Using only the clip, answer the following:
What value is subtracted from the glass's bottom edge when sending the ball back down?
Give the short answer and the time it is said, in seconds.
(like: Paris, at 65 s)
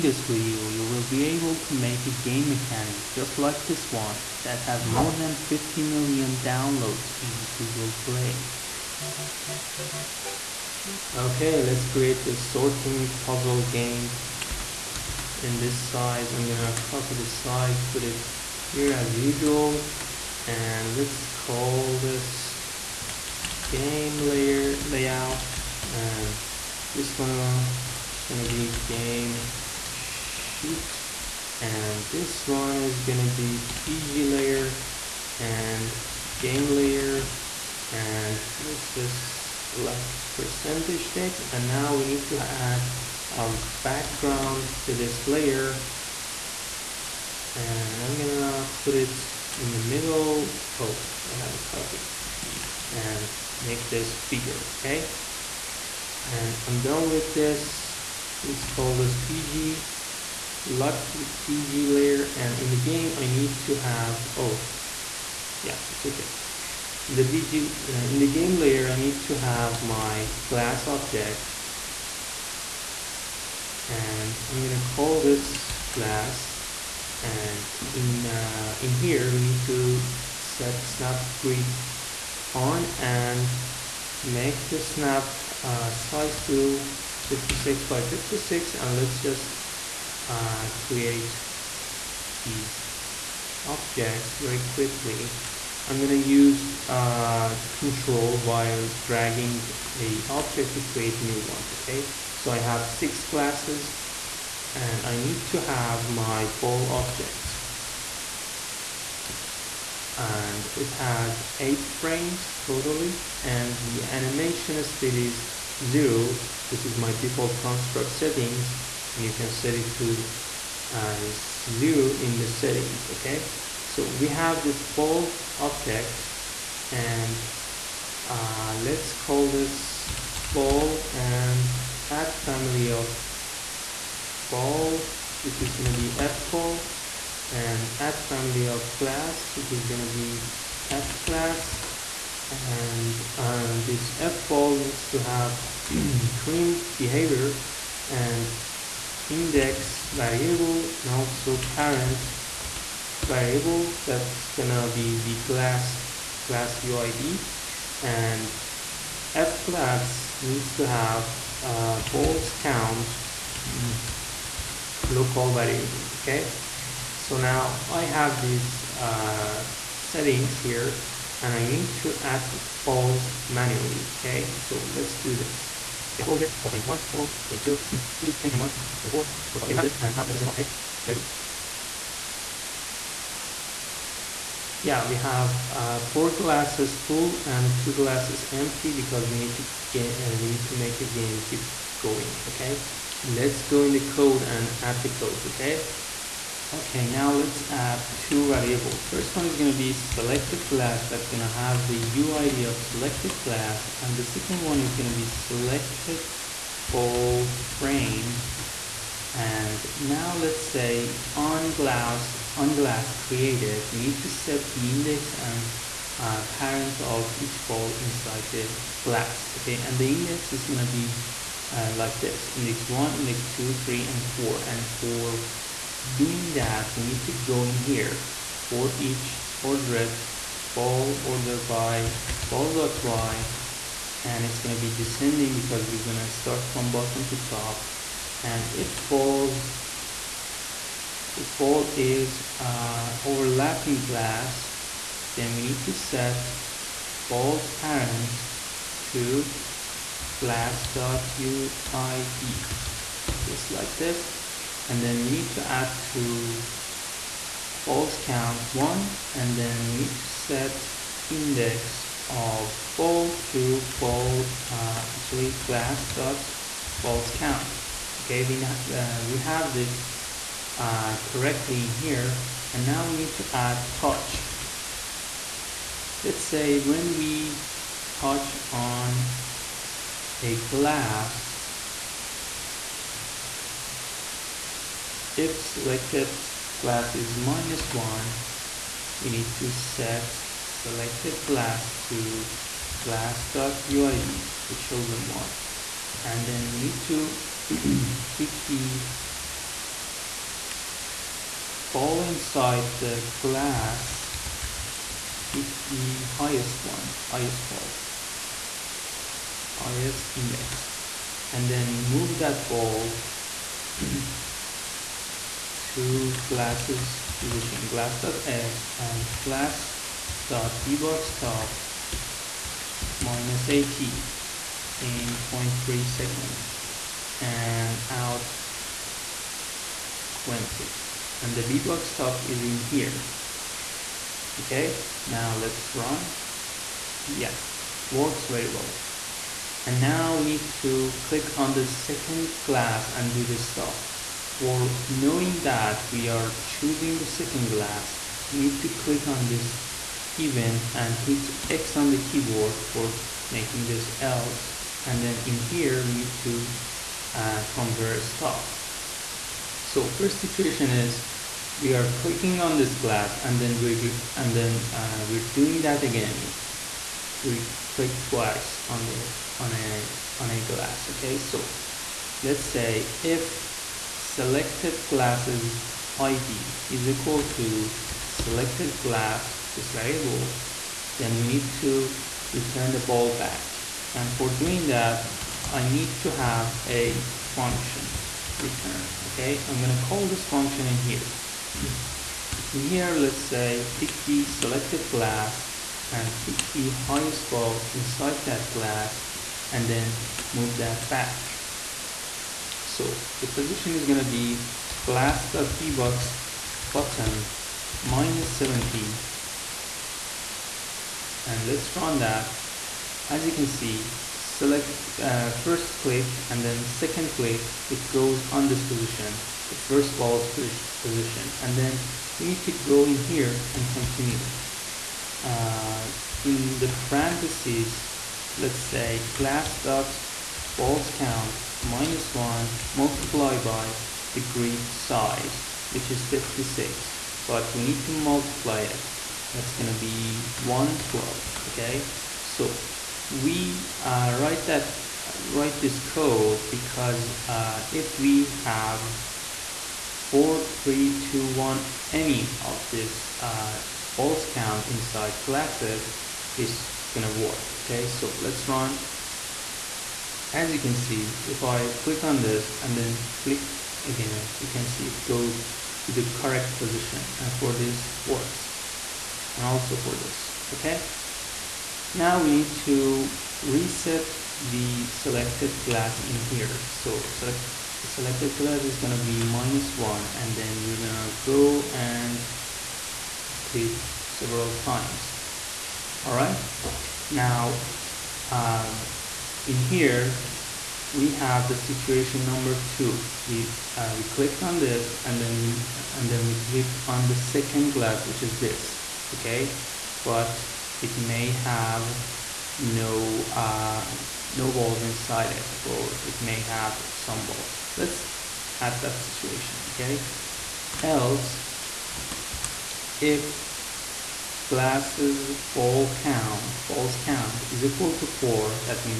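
70, at 408 s.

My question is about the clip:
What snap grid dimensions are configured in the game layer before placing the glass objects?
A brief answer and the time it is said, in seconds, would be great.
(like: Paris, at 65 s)
56 by 56, at 87 s.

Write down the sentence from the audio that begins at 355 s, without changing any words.
And then in here, we need to uh, compare stuff.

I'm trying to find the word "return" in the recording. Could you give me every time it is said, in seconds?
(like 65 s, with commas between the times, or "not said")
382 s, 388 s.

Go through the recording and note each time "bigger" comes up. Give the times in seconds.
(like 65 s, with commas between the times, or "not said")
54 s.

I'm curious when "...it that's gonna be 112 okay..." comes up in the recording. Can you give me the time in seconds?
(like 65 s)
438 s.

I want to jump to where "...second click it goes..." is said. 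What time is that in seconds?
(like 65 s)
416 s.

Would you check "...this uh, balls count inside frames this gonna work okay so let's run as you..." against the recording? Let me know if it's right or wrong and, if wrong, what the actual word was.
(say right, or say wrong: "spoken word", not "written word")
wrong: "classes", not "frames".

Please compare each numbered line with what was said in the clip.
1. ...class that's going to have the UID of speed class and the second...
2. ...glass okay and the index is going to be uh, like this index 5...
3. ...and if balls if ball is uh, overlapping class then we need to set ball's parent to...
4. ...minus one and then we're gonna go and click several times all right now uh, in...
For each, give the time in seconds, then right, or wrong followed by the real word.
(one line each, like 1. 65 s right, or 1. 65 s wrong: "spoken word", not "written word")
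1. 200 s wrong: "selected", not "speed"
2. 219 s wrong: "1", not "5"
3. 238 s right
4. 479 s right.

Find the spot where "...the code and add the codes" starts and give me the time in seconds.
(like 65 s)
193 s.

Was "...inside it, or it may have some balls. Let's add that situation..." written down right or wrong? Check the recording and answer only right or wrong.
right.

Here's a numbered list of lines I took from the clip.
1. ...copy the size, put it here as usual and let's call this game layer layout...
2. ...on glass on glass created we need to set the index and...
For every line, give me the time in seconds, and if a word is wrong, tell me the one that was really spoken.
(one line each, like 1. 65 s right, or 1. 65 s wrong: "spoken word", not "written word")
1. 16 s right
2. 211 s right.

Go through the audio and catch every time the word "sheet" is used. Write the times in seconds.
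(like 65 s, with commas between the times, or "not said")
29 s.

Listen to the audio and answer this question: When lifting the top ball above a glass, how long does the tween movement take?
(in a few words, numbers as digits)
0.3 seconds.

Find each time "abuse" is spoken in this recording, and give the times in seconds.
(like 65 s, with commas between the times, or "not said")
not said.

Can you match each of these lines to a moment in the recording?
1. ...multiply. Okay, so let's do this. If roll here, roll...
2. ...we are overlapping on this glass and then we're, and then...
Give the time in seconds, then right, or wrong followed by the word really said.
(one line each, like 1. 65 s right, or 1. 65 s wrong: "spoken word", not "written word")
1. 173 s wrong: "manually", not "multiply"
2. 361 s wrong: "clicking", not "overlapping".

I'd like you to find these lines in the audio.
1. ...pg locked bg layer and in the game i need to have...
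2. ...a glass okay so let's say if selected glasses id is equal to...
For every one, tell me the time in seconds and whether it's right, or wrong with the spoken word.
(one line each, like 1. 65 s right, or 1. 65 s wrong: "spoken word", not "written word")
1. 59 s right
2. 370 s right.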